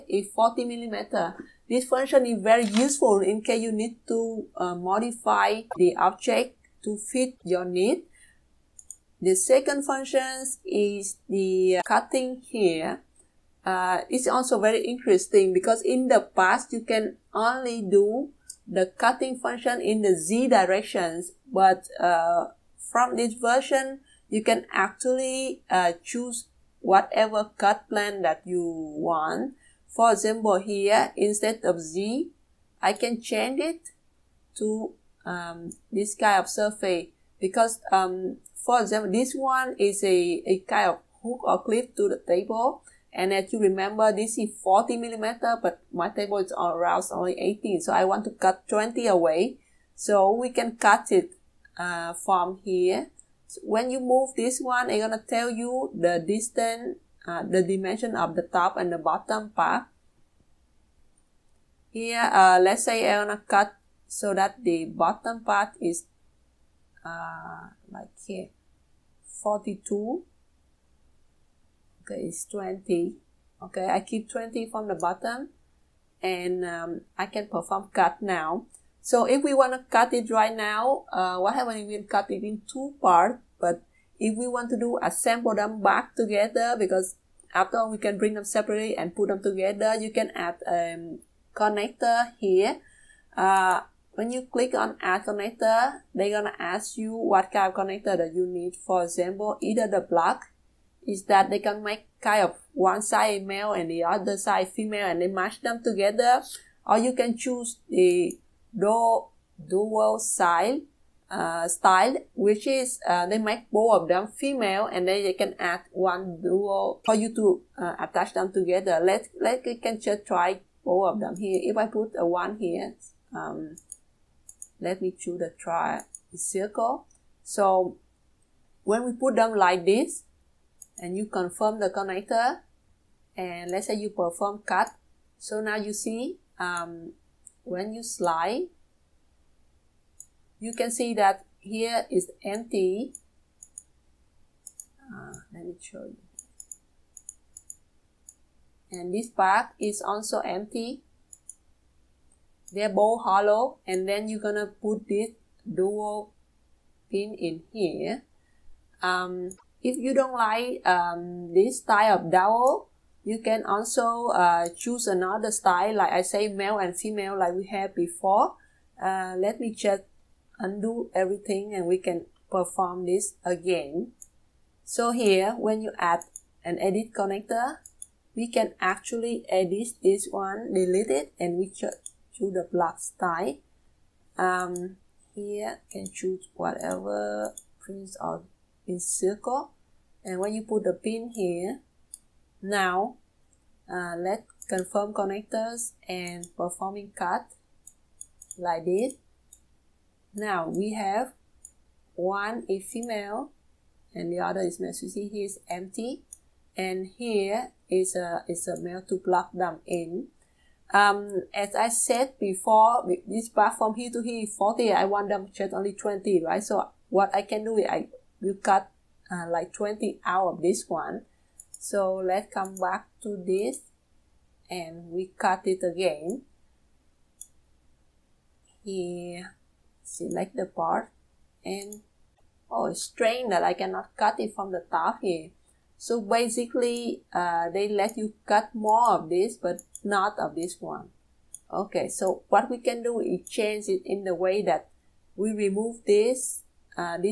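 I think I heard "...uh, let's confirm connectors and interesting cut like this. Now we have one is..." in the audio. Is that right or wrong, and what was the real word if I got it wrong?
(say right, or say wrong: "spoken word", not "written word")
wrong: "performing", not "interesting".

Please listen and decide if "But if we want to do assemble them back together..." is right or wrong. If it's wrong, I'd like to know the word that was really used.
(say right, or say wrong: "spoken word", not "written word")
right.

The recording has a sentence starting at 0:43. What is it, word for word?
And as you remember, this is 40 millimeter, but my table is around only 18.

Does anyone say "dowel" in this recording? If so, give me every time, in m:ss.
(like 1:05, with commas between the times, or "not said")
1:49, 1:56, 2:35, 2:42.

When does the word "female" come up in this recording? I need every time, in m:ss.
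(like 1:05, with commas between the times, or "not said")
1:44, 1:54, 2:46, 3:22.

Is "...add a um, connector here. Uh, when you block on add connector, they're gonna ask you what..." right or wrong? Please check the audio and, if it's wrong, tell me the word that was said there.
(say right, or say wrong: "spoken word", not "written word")
wrong: "click", not "block".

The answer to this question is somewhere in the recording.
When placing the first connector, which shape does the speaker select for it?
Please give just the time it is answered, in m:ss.
2:05.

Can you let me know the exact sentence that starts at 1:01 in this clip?
Here, uh, let's say I'm gonna cut so that the bottom part is uh, like here, 42.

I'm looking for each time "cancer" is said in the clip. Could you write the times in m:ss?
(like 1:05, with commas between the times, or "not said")
not said.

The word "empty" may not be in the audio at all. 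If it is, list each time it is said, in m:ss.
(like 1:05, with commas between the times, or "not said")
2:22, 2:30, 3:25.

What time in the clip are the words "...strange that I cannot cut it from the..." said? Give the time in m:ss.
3:53.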